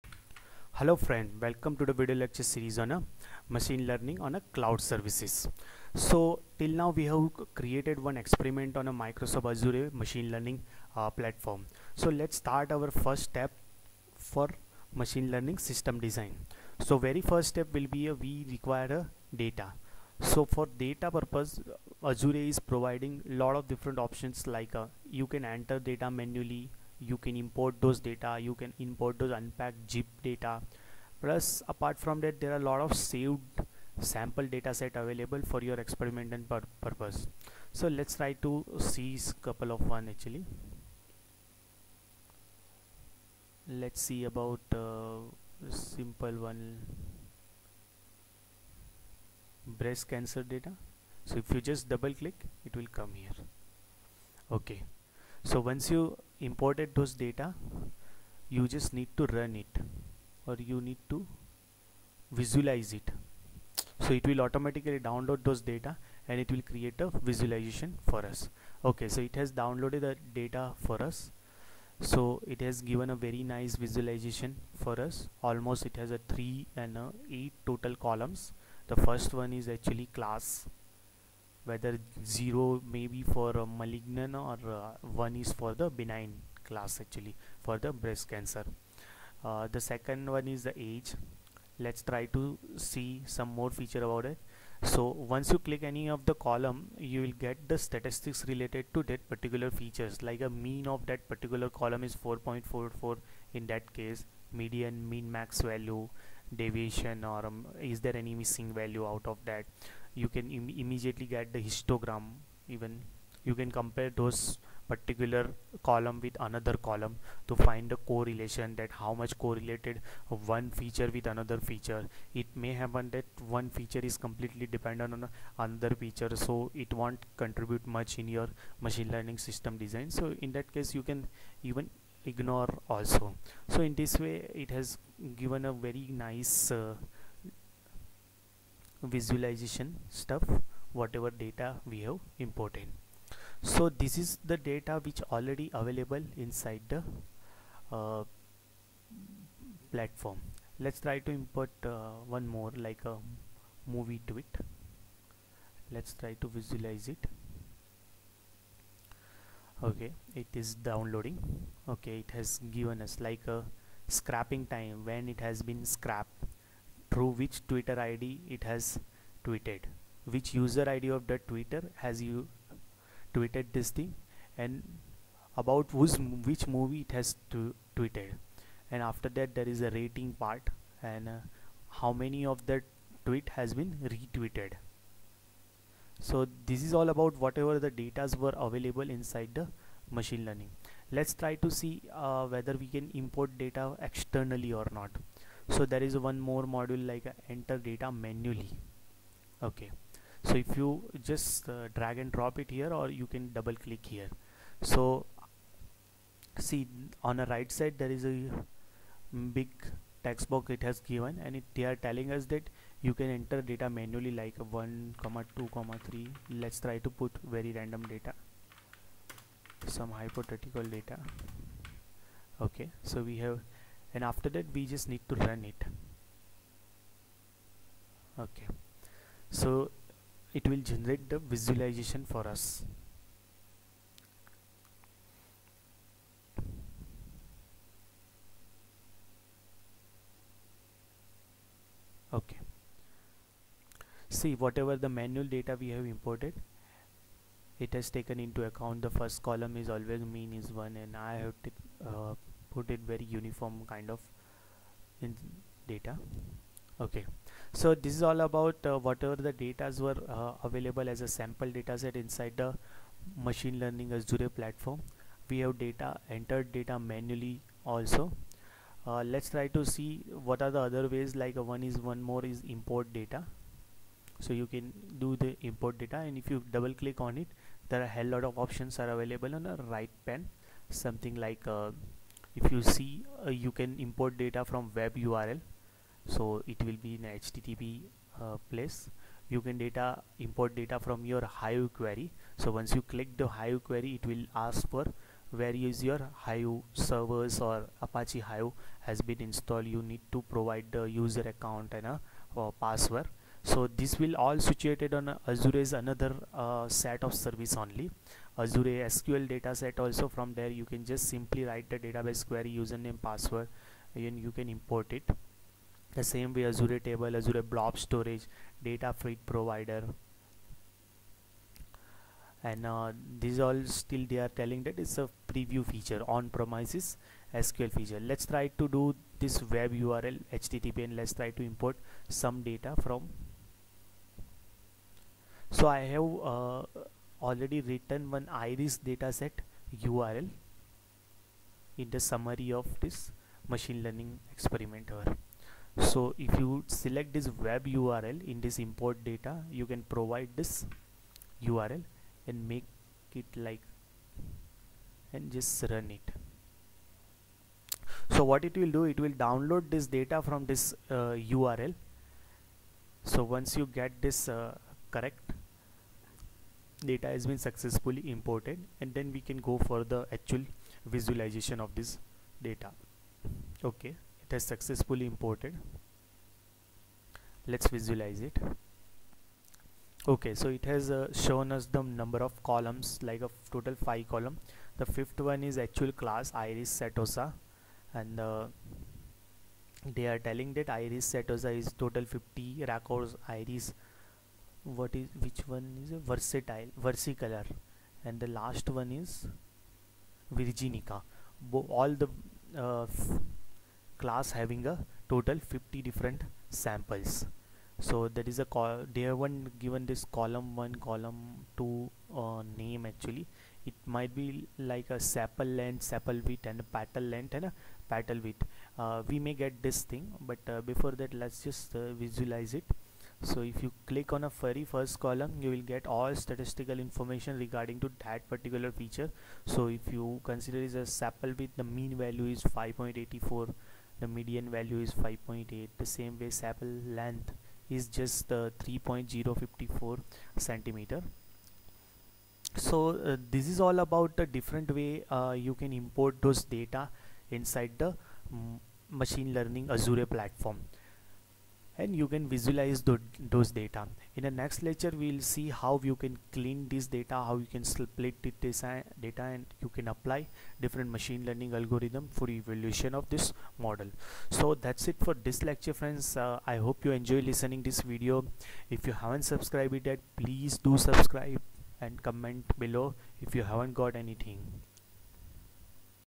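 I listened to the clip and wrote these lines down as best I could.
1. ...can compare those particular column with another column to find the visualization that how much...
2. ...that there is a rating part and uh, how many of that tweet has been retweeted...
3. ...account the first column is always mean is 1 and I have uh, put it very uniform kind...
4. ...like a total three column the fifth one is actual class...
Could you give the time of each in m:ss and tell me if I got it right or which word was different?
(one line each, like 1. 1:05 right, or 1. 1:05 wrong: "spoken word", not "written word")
1. 1:53 wrong: "correlation", not "visualization"
2. 2:59 right
3. 4:08 right
4. 6:23 wrong: "five", not "three".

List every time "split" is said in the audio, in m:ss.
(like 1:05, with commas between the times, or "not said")
7:37.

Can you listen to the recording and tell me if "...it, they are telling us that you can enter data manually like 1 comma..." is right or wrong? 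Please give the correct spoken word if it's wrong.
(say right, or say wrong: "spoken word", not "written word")
right.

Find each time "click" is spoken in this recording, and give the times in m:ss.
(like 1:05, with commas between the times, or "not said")
0:52, 1:35, 3:23, 4:37, 4:53, 7:04.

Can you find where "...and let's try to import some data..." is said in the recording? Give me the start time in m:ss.
5:31.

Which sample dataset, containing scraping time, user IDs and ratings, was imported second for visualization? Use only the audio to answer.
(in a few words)
Movie tweets.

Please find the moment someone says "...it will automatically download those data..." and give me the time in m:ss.
1:04.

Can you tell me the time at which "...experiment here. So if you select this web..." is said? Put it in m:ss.
5:44.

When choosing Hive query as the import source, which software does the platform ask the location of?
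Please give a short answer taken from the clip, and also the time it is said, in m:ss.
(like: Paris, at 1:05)
Apache Hive, at 4:58.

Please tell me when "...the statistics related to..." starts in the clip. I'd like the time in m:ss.
1:37.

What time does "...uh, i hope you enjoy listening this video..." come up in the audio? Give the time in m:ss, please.
7:46.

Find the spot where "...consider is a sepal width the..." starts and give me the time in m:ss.
7:10.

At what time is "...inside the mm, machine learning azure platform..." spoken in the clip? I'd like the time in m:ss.
7:27.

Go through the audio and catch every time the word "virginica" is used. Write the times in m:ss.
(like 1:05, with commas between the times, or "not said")
6:40.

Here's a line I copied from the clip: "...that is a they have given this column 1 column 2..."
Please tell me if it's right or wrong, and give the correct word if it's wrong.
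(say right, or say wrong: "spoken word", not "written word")
right.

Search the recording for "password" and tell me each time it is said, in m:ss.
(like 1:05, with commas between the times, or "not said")
5:02, 5:13.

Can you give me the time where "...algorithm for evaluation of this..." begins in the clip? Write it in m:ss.
7:41.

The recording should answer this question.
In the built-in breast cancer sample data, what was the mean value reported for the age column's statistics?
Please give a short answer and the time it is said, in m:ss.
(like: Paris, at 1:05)
4.44, at 1:42.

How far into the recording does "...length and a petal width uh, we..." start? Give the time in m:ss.
6:57.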